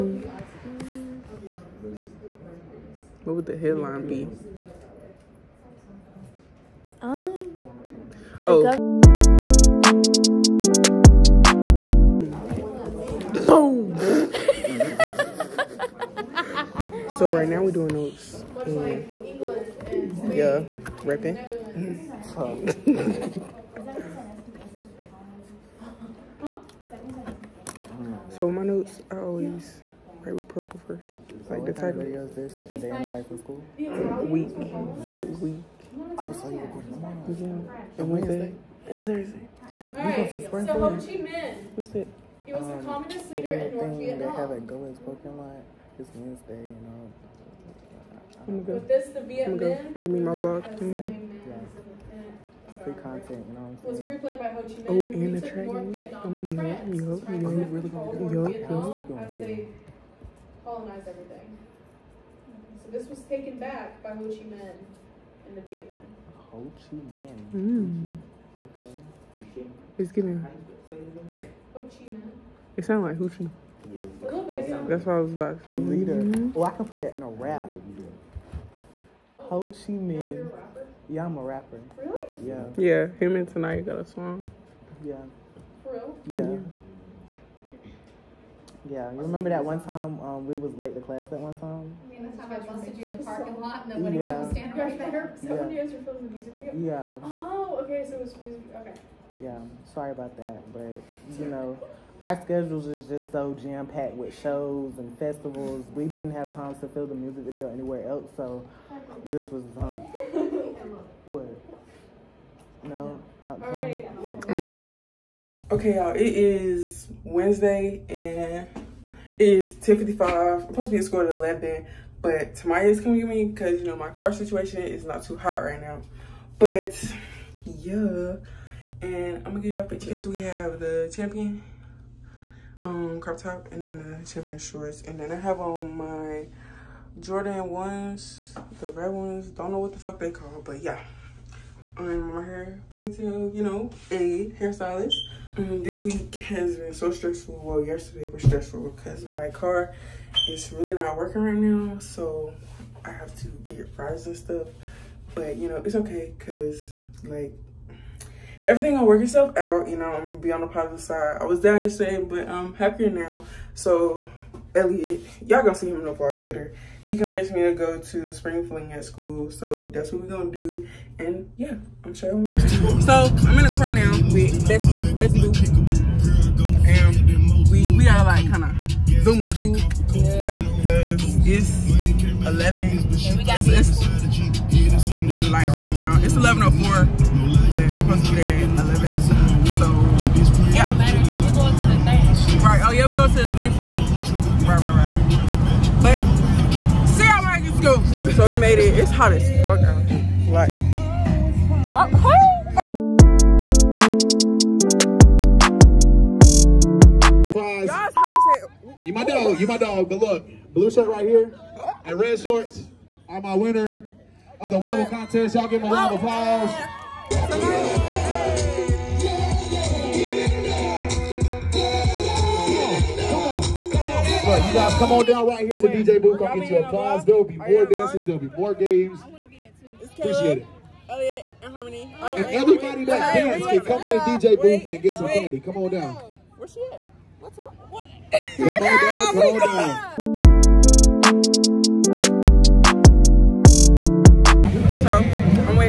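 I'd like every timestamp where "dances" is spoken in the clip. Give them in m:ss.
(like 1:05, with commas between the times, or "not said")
3:47, 3:53.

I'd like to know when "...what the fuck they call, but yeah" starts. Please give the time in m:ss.
2:19.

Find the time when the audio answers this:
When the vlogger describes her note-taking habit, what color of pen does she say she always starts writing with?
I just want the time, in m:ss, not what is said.
0:30.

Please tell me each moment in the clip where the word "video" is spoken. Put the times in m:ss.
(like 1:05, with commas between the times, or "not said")
0:32, 1:36, 1:47.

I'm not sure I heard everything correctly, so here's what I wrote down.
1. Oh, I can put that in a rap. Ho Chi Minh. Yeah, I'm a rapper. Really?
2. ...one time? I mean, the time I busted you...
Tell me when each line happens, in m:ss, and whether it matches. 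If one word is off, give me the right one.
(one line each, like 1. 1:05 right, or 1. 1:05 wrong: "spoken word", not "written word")
1. 1:16 right
2. 1:31 right.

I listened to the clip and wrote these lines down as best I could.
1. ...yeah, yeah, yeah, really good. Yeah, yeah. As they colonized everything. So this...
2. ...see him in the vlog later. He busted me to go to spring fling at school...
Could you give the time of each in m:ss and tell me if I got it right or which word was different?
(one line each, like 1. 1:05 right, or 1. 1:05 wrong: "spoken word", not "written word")
1. 0:56 right
2. 2:45 wrong: "convinced", not "busted".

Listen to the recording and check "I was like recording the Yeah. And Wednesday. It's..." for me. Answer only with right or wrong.
right.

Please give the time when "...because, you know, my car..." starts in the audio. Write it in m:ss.
2:03.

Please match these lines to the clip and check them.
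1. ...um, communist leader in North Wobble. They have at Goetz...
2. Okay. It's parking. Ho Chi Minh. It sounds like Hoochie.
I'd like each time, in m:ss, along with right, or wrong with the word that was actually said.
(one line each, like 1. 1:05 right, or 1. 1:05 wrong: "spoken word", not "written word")
1. 0:42 wrong: "Vietnam", not "Wobble"
2. 1:08 wrong: "giving", not "parking".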